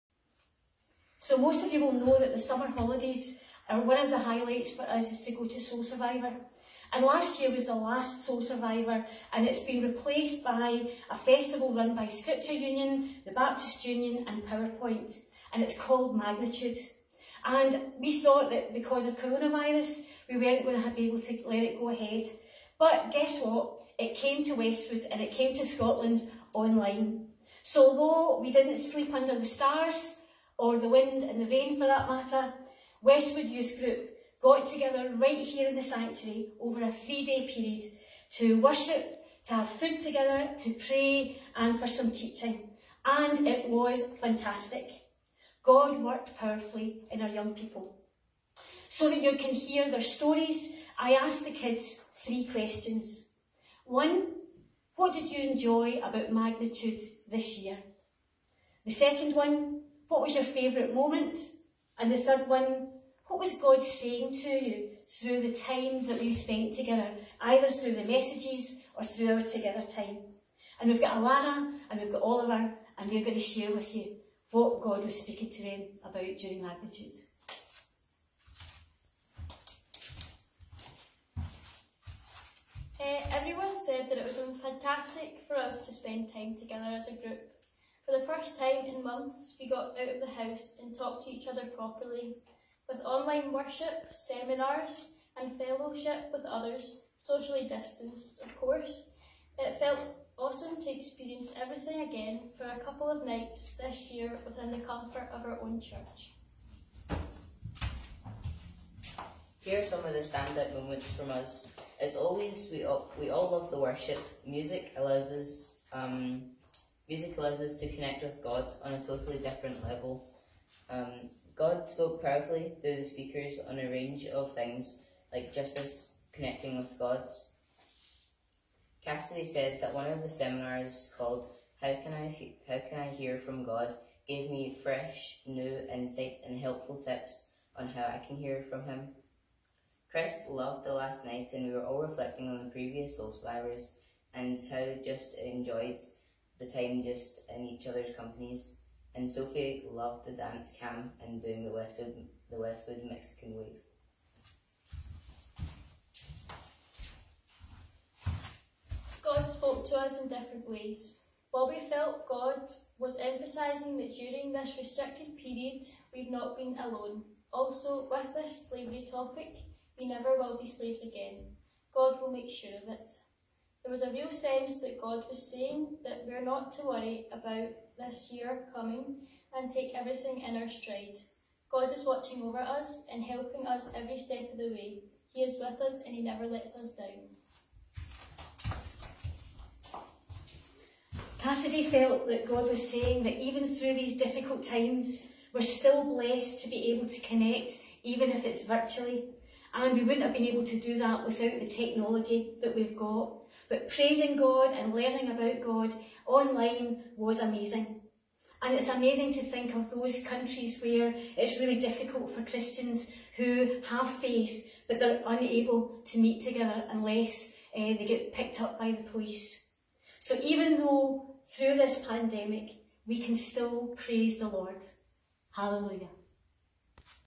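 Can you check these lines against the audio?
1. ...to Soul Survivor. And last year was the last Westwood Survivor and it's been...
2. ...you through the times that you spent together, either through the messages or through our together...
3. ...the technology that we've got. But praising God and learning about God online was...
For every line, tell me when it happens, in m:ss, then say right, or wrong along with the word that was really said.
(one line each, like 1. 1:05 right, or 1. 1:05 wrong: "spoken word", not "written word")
1. 0:05 wrong: "Soul", not "Westwood"
2. 1:04 right
3. 3:21 right.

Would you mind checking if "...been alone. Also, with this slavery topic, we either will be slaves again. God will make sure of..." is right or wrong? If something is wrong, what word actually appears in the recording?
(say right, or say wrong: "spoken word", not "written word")
wrong: "never", not "either".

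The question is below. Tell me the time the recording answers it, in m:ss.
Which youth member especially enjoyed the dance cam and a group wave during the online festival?
2:29.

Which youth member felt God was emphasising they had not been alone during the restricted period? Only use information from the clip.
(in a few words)
Bobby.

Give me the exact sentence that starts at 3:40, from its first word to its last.
So even though through this pandemic, we can still praise the Lord.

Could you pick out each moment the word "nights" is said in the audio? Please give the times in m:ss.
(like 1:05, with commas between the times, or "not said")
1:43, 2:21.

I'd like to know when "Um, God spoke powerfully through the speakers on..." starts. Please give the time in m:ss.
2:00.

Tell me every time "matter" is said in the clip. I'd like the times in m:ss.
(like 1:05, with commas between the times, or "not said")
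0:32.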